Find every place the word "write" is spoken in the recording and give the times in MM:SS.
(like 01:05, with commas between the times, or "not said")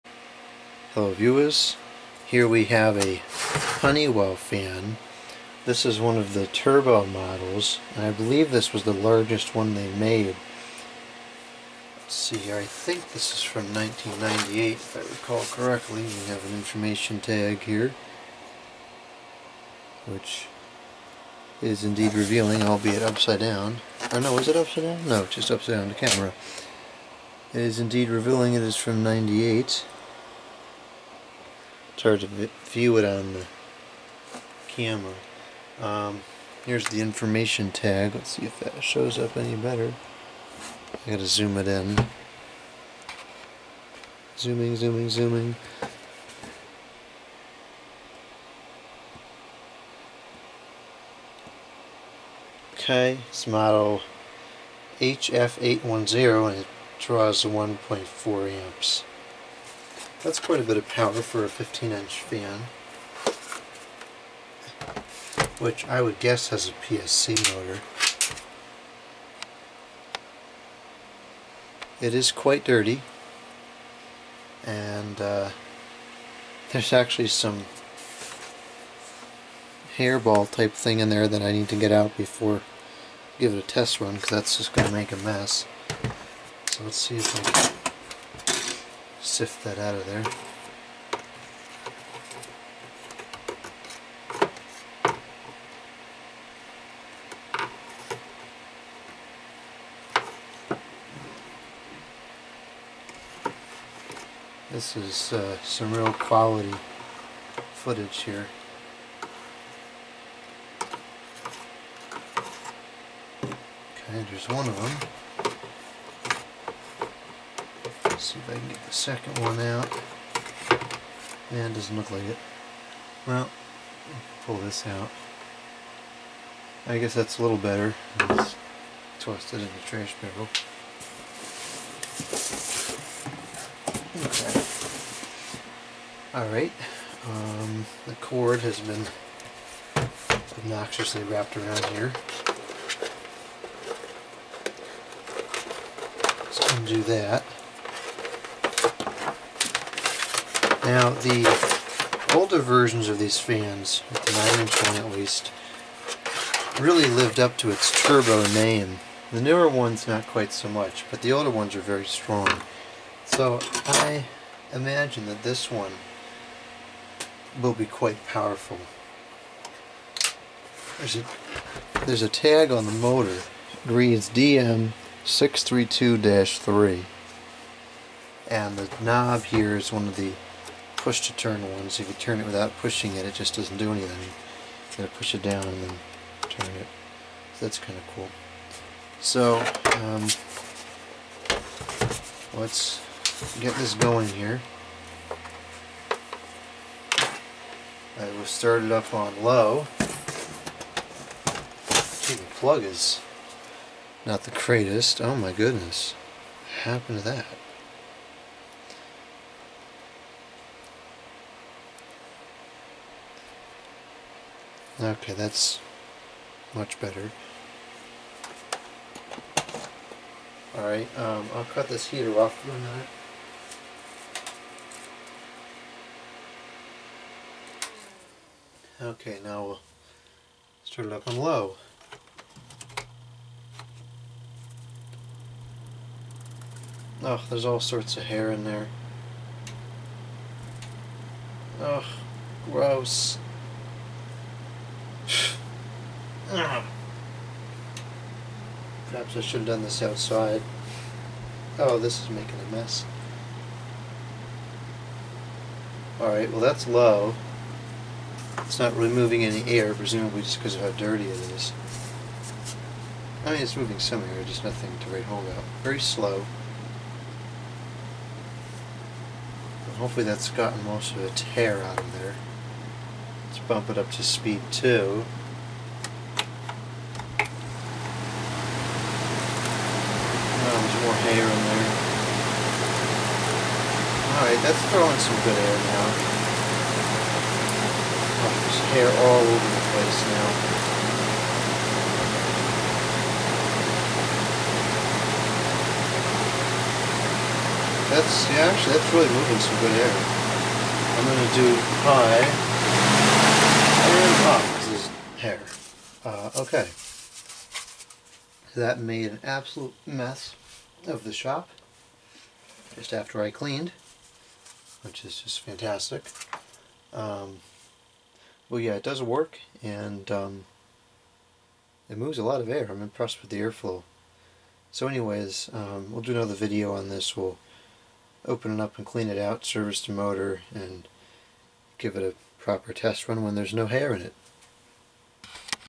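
04:25.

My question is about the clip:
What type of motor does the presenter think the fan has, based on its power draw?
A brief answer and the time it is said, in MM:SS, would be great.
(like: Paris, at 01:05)
PSC motor, at 01:06.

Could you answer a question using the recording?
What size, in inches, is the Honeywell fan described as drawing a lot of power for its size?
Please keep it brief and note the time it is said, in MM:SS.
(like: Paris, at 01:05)
15-inch, at 01:01.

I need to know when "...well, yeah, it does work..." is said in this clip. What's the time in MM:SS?
05:18.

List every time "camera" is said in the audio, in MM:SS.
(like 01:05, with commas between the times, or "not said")
00:25, 00:34.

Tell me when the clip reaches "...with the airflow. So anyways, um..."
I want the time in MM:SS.
05:23.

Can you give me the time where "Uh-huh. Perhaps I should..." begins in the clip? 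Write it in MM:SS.
04:06.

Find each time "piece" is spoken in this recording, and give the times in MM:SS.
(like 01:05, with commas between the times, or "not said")
not said.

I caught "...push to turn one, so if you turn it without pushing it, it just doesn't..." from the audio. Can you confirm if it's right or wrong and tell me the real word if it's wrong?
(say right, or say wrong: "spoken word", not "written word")
right.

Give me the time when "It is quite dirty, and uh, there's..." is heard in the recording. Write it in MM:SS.
01:11.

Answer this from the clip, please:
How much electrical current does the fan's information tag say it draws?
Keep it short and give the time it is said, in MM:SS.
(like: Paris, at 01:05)
1.4 amps, at 00:57.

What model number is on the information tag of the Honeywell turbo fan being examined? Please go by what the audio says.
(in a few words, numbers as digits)
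HF810.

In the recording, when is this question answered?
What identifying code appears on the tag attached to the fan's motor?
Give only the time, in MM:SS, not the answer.
02:54.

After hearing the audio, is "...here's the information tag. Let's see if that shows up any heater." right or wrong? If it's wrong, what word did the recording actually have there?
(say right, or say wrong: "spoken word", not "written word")
wrong: "better", not "heater".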